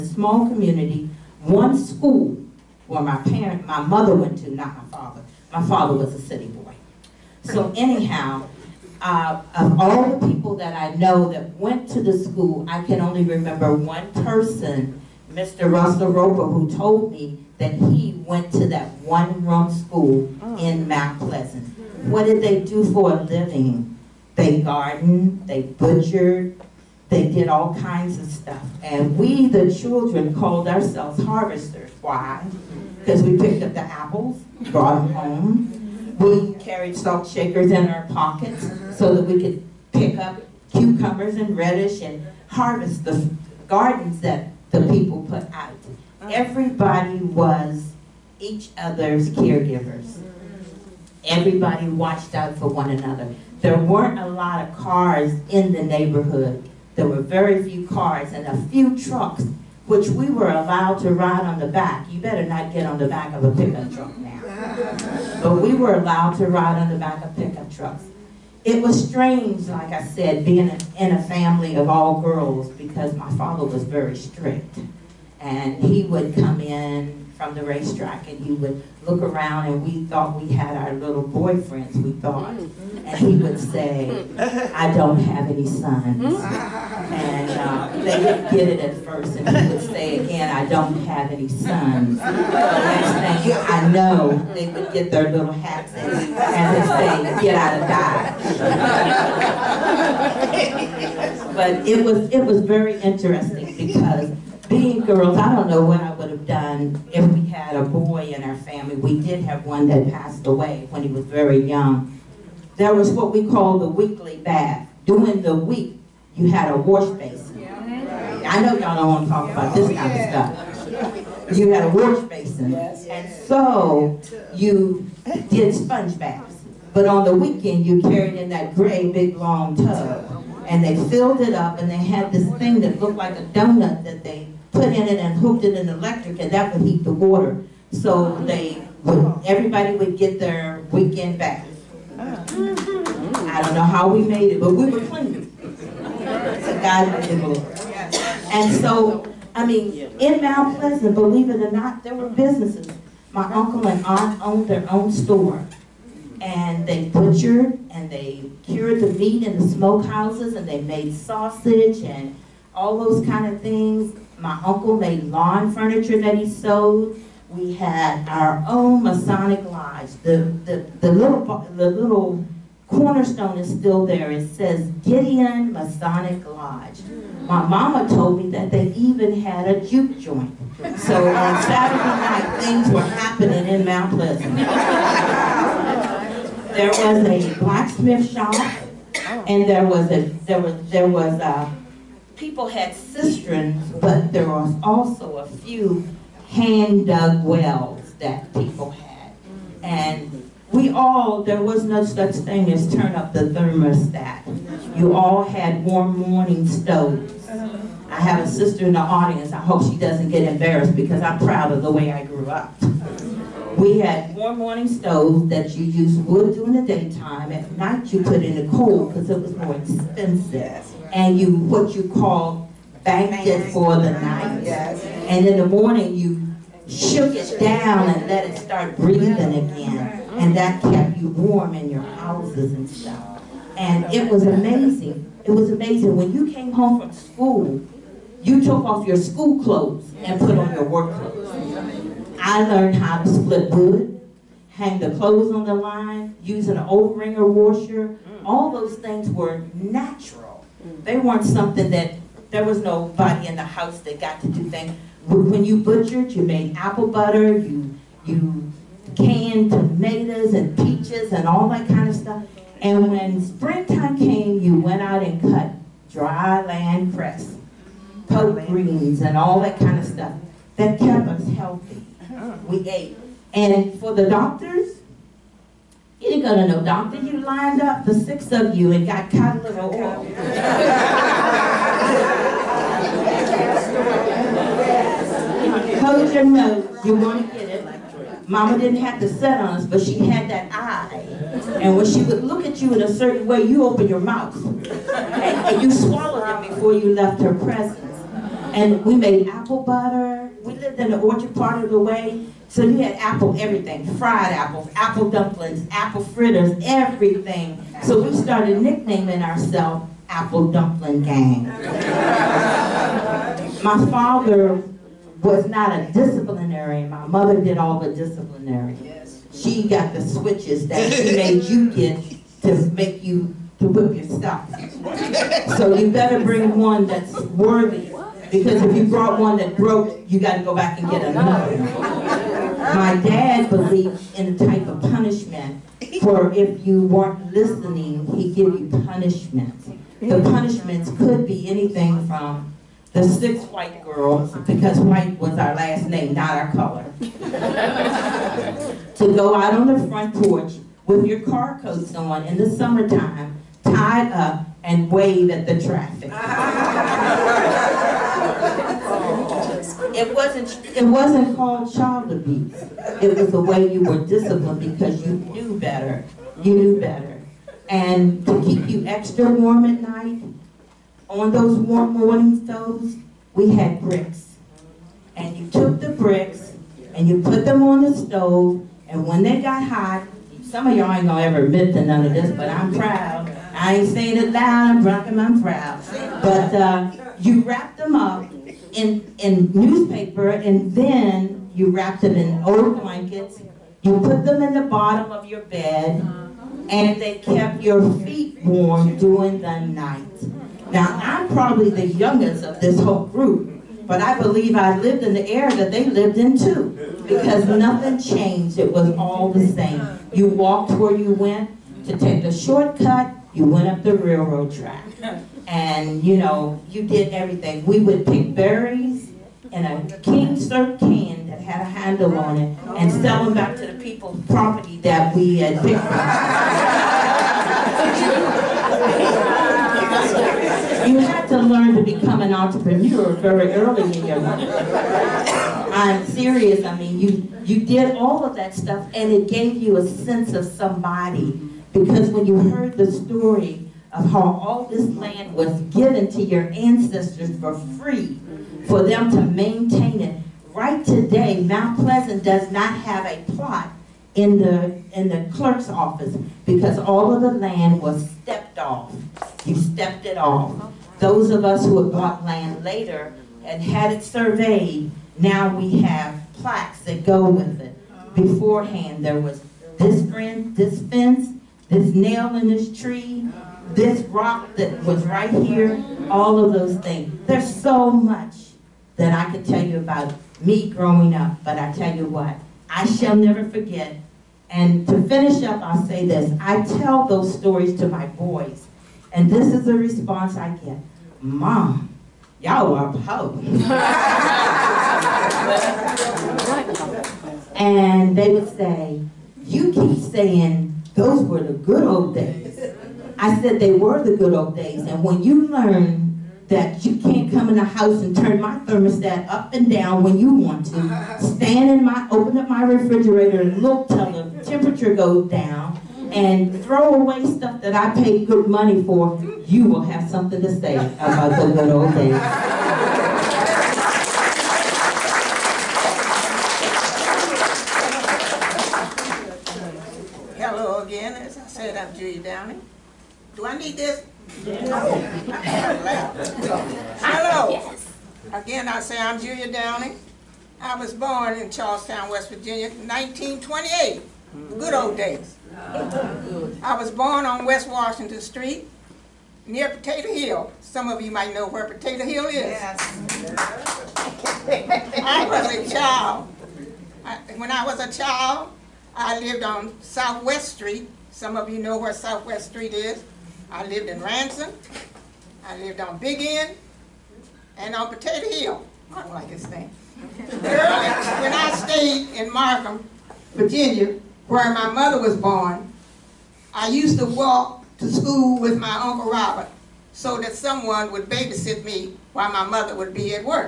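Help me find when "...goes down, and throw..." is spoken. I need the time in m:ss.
8:35.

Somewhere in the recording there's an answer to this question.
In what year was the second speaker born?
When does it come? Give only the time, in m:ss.
9:02.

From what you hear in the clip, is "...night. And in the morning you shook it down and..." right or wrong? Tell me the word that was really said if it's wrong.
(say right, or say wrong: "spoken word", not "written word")
right.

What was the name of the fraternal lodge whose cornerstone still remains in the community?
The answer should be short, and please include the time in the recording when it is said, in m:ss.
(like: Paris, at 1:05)
Gideon Masonic Lodge, at 2:55.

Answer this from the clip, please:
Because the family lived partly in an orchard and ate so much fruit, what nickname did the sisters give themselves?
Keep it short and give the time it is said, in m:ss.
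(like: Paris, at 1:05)
Apple Dumpling Gang, at 5:10.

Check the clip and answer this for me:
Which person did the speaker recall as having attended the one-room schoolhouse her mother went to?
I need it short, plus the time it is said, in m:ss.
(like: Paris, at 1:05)
Russell Roper, at 0:15.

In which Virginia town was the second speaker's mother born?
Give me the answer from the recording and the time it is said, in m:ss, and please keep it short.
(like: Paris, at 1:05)
Markham, at 9:32.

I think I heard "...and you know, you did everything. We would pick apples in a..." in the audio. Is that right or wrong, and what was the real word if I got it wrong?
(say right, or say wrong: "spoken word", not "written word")
wrong: "berries", not "apples".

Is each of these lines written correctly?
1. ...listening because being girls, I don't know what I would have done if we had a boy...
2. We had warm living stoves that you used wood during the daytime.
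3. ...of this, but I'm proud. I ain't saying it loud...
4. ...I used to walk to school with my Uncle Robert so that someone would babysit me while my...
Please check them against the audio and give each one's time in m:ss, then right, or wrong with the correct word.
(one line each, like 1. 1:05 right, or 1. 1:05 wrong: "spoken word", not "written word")
1. 1:43 wrong: "interesting", not "listening"
2. 3:33 wrong: "morning", not "living"
3. 6:22 right
4. 9:36 right.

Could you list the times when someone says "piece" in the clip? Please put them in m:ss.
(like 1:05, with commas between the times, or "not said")
not said.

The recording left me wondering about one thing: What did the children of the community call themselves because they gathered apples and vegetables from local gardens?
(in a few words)
harvesters.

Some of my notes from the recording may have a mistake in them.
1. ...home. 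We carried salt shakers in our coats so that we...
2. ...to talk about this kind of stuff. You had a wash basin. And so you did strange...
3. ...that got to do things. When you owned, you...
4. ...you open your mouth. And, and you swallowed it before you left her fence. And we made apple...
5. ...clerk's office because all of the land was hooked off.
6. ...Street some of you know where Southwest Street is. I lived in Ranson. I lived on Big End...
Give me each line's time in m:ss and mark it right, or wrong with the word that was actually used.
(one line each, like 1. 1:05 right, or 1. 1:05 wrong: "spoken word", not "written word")
1. 0:35 wrong: "pockets", not "coats"
2. 1:59 wrong: "sponge", not "strange"
3. 4:13 wrong: "butchered", not "owned"
4. 4:53 wrong: "presence", not "fence"
5. 7:35 wrong: "stepped", not "hooked"
6. 9:20 right.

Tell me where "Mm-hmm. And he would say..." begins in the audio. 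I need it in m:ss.
1:22.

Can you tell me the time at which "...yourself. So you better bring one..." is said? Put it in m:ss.
5:24.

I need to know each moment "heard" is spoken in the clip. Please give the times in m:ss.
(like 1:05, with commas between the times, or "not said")
7:22.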